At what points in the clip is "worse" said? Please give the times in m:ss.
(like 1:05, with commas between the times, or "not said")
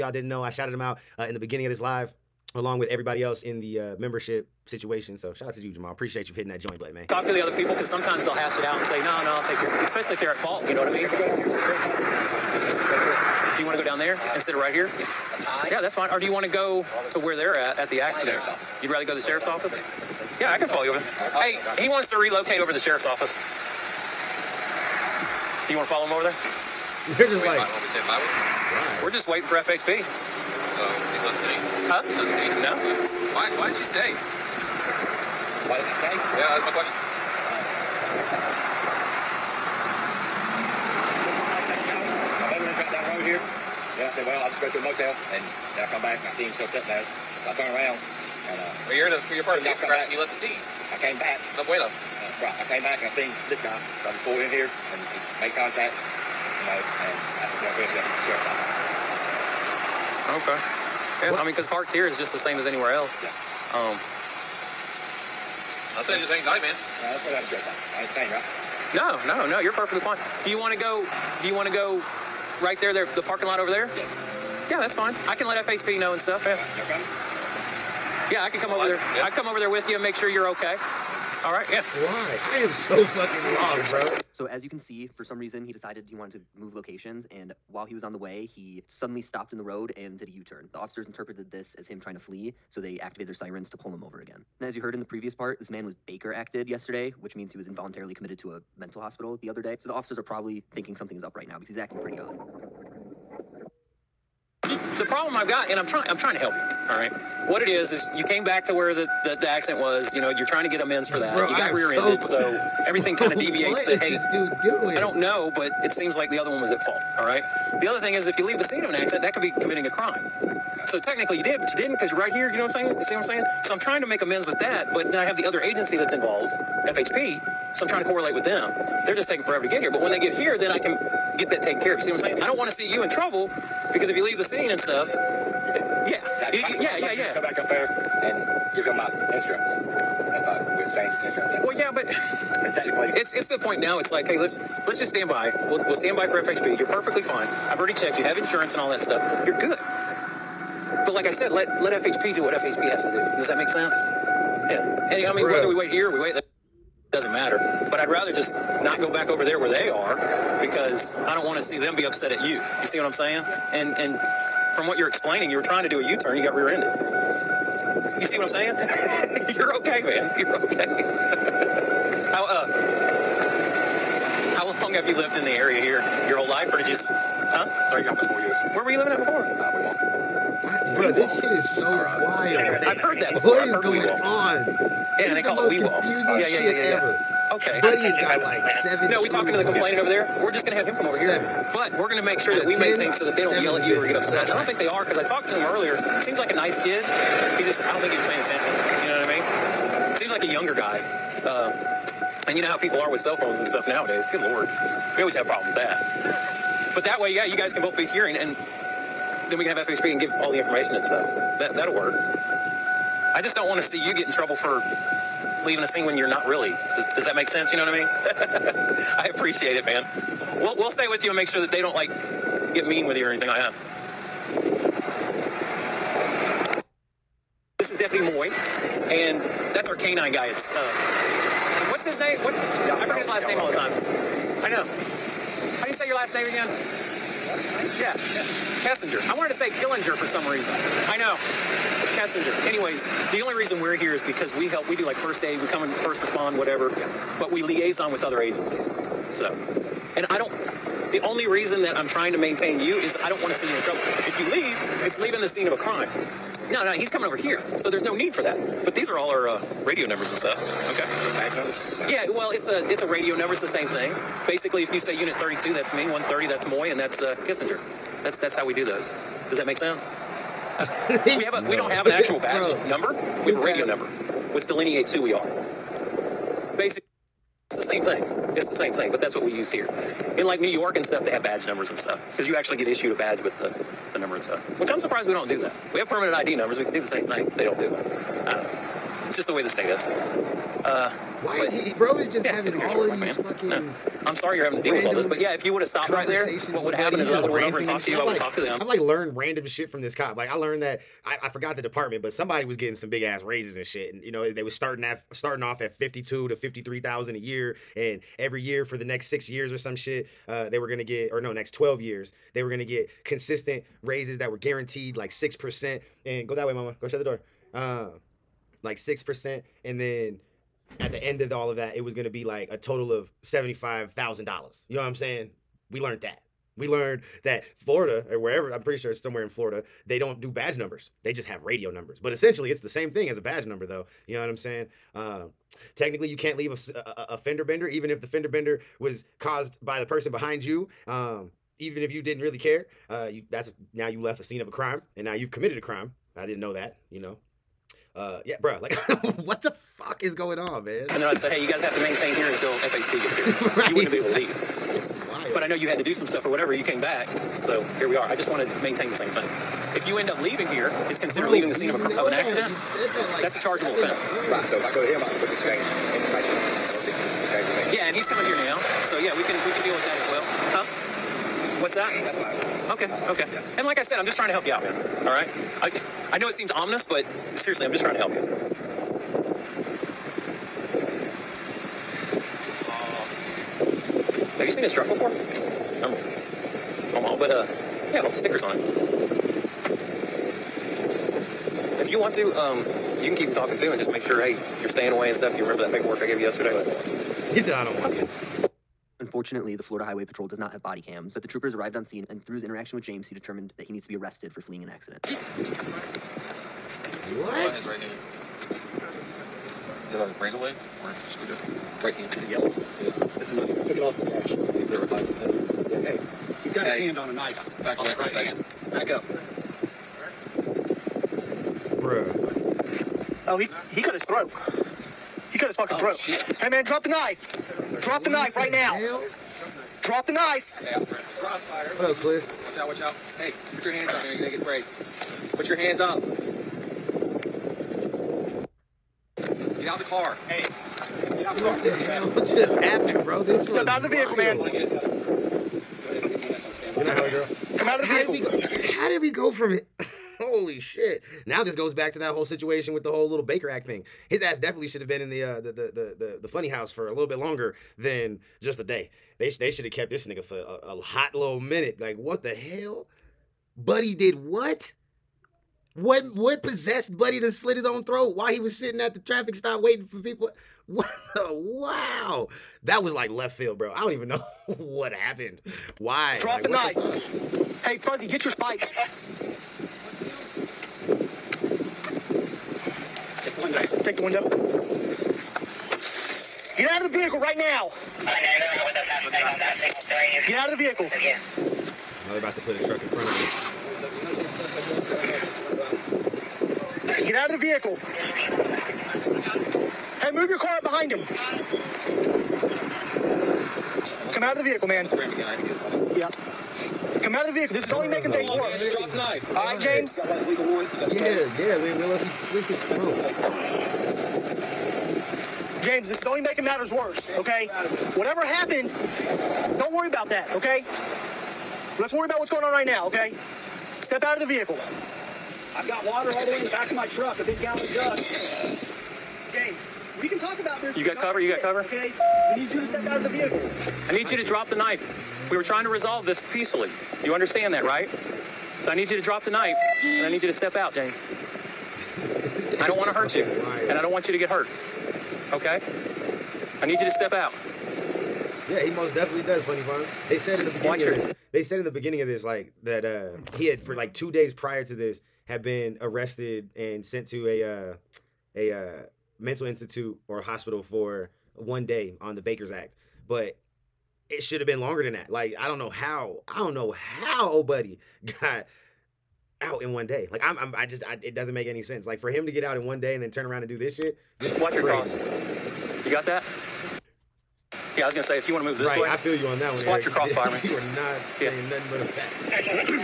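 8:28, 8:36.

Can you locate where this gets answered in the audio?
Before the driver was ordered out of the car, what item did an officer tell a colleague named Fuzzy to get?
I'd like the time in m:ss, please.
7:58.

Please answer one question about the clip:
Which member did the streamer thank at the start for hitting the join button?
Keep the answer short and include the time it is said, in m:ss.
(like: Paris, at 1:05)
Jamal, at 0:05.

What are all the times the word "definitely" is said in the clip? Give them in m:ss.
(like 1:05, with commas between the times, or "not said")
7:34, 9:09.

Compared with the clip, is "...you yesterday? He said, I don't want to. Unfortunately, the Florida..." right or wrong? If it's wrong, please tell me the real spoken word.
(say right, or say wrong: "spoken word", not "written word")
right.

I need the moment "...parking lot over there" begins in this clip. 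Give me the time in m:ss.
1:13.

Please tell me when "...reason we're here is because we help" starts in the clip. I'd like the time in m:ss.
4:03.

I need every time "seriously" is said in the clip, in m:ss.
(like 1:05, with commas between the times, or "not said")
6:17.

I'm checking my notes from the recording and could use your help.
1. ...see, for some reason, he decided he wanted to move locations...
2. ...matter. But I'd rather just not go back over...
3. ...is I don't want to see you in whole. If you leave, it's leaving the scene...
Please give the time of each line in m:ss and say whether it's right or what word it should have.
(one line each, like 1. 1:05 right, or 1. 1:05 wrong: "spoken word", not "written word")
1. 1:24 right
2. 2:37 right
3. 4:12 wrong: "trouble", not "whole".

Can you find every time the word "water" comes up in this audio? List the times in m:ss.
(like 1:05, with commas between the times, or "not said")
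8:46.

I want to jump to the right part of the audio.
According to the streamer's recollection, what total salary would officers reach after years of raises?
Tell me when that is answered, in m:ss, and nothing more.
5:23.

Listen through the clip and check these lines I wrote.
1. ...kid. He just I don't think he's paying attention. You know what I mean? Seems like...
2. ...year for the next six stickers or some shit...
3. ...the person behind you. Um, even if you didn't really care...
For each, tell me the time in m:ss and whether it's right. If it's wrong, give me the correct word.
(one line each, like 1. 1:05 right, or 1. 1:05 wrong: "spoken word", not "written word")
1. 3:16 right
2. 5:08 wrong: "years", not "stickers"
3. 5:39 right.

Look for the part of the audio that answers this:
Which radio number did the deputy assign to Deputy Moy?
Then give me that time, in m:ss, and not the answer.
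4:26.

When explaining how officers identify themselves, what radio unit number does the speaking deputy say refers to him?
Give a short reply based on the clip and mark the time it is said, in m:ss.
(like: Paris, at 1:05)
32, at 4:25.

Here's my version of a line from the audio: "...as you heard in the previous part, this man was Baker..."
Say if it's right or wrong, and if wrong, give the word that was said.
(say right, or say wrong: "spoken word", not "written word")
right.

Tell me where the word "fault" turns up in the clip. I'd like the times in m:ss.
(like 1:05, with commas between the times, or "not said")
0:10, 1:56.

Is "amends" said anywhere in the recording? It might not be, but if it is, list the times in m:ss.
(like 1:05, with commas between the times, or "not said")
1:50, 2:04.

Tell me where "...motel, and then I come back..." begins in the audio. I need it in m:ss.
0:44.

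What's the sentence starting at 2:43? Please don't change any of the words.
And and from what you're explaining, you were trying to do a U-turn, you got rear-ended.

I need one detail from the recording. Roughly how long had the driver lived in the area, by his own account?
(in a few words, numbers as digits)
Almost 4 years.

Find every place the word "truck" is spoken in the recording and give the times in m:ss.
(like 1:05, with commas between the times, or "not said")
6:24, 8:12, 8:47.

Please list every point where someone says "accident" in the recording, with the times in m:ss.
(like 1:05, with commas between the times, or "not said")
0:17, 1:49, 1:58, 6:02, 6:44.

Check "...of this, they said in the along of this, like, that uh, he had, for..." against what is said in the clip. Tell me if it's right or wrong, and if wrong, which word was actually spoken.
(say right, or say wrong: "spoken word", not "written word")
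wrong: "beginning", not "along".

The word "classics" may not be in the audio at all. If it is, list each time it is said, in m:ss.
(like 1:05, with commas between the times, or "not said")
not said.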